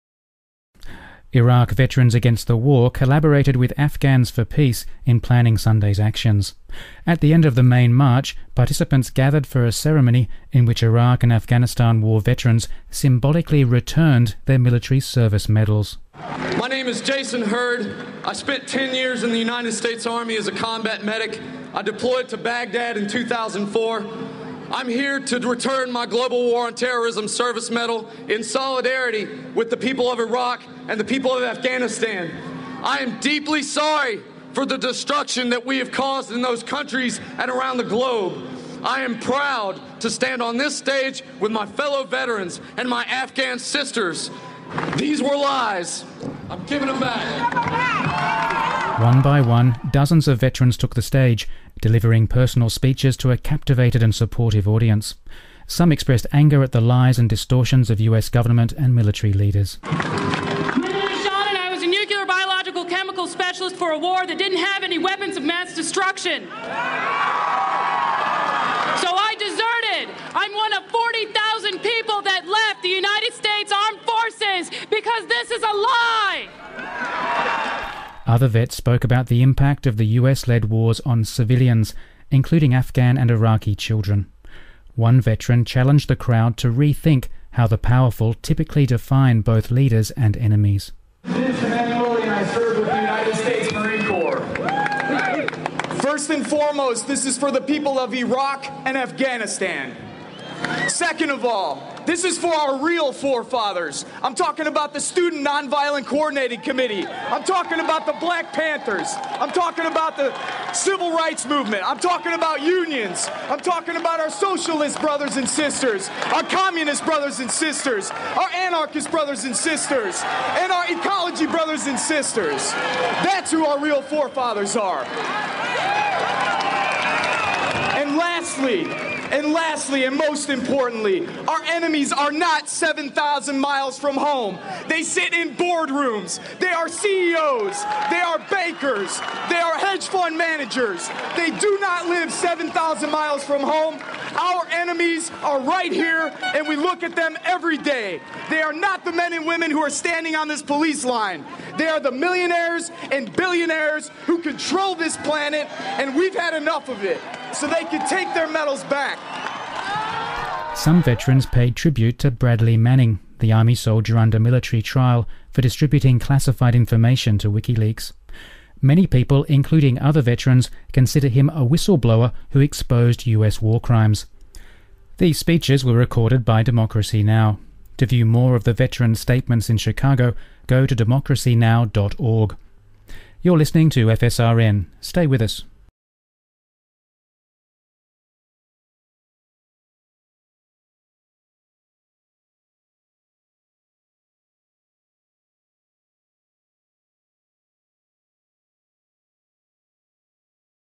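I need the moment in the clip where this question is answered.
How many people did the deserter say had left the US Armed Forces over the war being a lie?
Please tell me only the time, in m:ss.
1:10.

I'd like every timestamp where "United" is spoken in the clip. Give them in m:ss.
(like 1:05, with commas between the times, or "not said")
0:19, 1:12, 1:32.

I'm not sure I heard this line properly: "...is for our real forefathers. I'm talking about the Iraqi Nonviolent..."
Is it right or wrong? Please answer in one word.
wrong.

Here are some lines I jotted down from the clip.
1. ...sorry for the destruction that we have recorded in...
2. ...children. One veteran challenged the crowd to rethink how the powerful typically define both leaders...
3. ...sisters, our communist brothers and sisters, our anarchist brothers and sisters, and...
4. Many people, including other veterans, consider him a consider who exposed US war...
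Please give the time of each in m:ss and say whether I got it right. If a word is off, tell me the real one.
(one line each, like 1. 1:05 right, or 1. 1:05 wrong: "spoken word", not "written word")
1. 0:33 wrong: "caused", not "recorded"
2. 1:23 right
3. 1:55 right
4. 2:48 wrong: "whistleblower", not "consider".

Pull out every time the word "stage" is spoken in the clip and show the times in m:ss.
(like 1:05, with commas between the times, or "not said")
0:40, 0:51.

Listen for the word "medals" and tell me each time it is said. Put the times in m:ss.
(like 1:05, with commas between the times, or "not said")
0:15, 0:27, 2:38.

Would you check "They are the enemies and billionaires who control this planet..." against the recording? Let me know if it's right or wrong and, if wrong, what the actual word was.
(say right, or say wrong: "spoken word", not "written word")
wrong: "millionaires", not "enemies".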